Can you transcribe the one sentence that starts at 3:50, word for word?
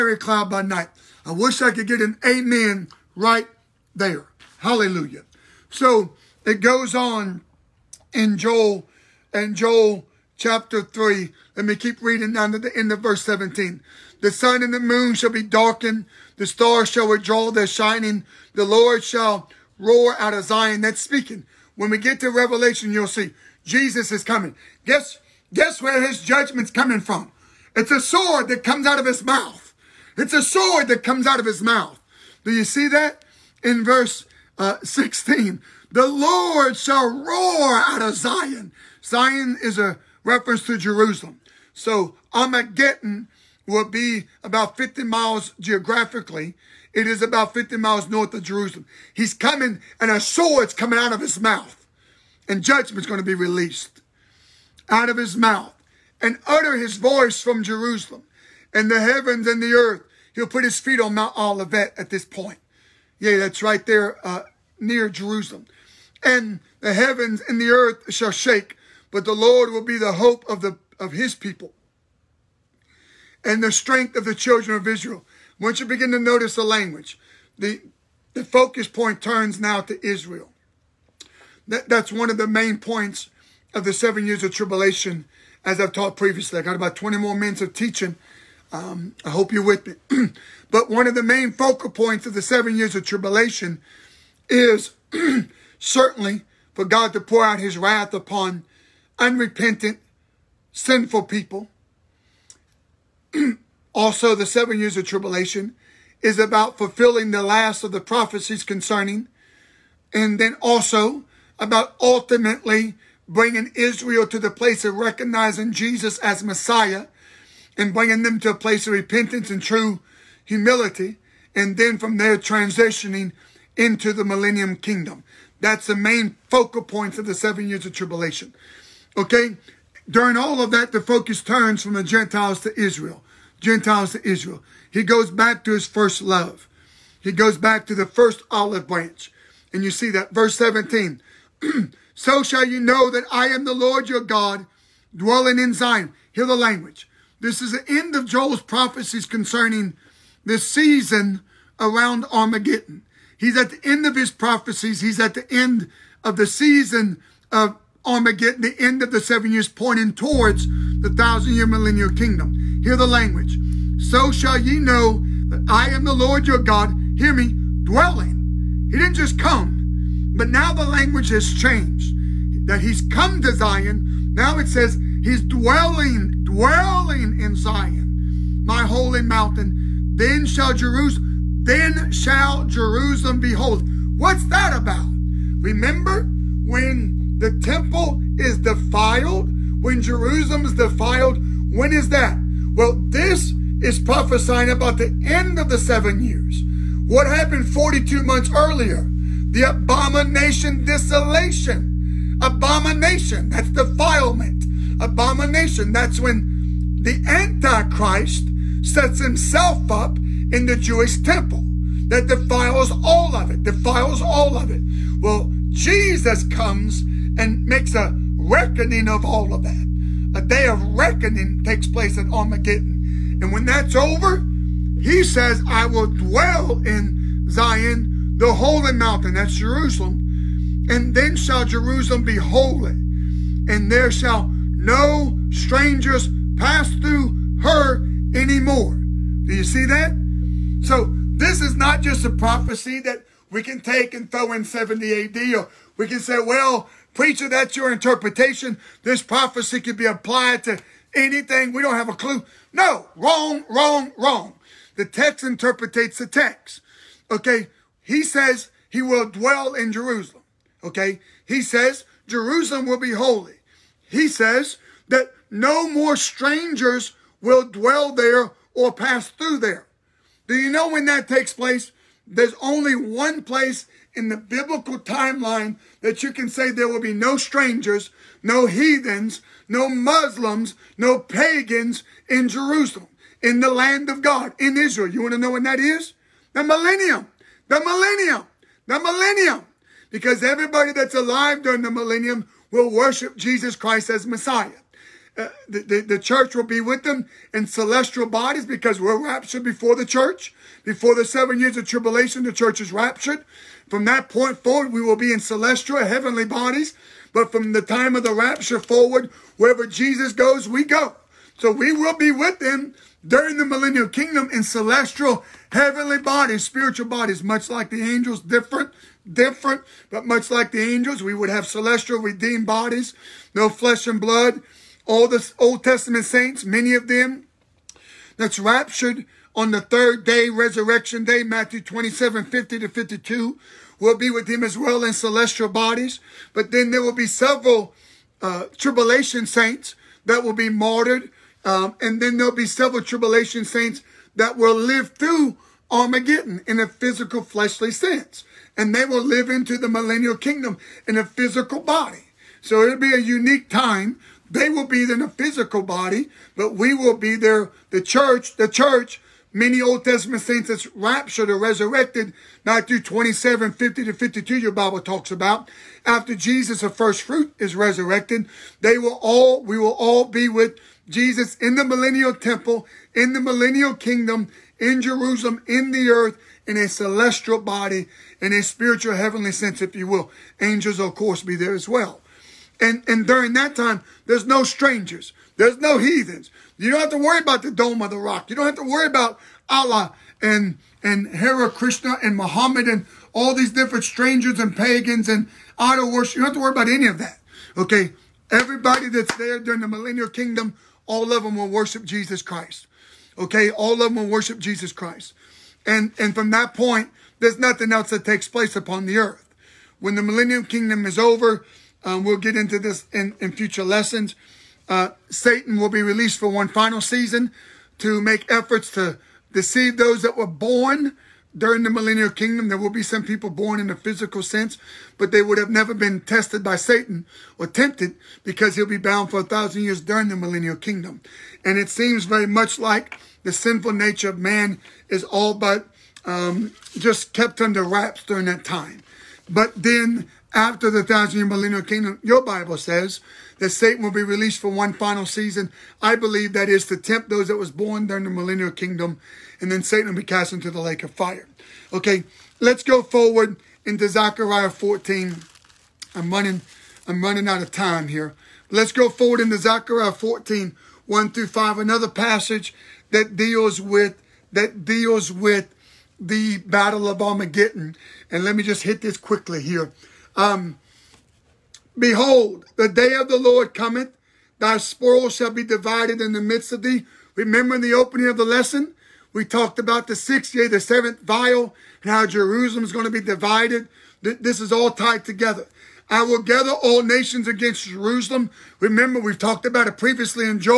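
And then shall Jerusalem be holy, and there shall no strangers pass through her anymore.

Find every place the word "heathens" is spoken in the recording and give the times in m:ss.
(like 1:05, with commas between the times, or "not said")
4:38, 6:25.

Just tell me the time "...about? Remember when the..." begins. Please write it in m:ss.
3:04.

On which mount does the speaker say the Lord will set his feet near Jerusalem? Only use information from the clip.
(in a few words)
Mount Olivet.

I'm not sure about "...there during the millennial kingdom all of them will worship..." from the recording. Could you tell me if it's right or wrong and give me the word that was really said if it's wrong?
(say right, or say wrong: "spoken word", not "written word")
right.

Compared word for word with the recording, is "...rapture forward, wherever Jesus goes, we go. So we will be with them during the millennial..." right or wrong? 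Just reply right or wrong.
right.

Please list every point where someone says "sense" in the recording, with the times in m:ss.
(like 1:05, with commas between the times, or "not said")
5:47, 6:19, 7:04.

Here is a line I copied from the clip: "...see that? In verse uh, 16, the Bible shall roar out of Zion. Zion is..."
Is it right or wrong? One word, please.
wrong.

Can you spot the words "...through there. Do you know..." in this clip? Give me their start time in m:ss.
4:29.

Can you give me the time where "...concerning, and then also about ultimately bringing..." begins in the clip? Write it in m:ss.
1:48.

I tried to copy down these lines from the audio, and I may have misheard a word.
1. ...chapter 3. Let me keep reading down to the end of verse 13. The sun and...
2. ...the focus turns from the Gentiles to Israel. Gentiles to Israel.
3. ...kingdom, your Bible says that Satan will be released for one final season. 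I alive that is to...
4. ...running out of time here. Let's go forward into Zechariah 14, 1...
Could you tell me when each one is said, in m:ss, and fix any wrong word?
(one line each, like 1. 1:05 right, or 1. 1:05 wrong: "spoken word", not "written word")
1. 0:10 wrong: "17", not "13"
2. 2:10 right
3. 7:21 wrong: "believe", not "alive"
4. 7:37 right.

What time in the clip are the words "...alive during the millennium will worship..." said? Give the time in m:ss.
4:51.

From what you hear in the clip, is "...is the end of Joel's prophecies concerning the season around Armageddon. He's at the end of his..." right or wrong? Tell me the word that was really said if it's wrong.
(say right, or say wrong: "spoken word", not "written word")
right.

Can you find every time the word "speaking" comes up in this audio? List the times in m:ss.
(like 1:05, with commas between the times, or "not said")
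0:20.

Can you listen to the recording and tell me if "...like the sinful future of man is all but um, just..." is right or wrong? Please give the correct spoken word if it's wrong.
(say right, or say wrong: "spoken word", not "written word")
wrong: "nature", not "future".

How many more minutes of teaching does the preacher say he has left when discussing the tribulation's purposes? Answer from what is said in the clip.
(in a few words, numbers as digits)
20.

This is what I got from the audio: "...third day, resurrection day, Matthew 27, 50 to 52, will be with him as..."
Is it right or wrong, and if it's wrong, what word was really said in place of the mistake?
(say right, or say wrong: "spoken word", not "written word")
right.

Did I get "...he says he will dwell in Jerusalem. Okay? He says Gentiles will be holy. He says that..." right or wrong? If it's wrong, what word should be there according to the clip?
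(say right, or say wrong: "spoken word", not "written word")
wrong: "Jerusalem", not "Gentiles".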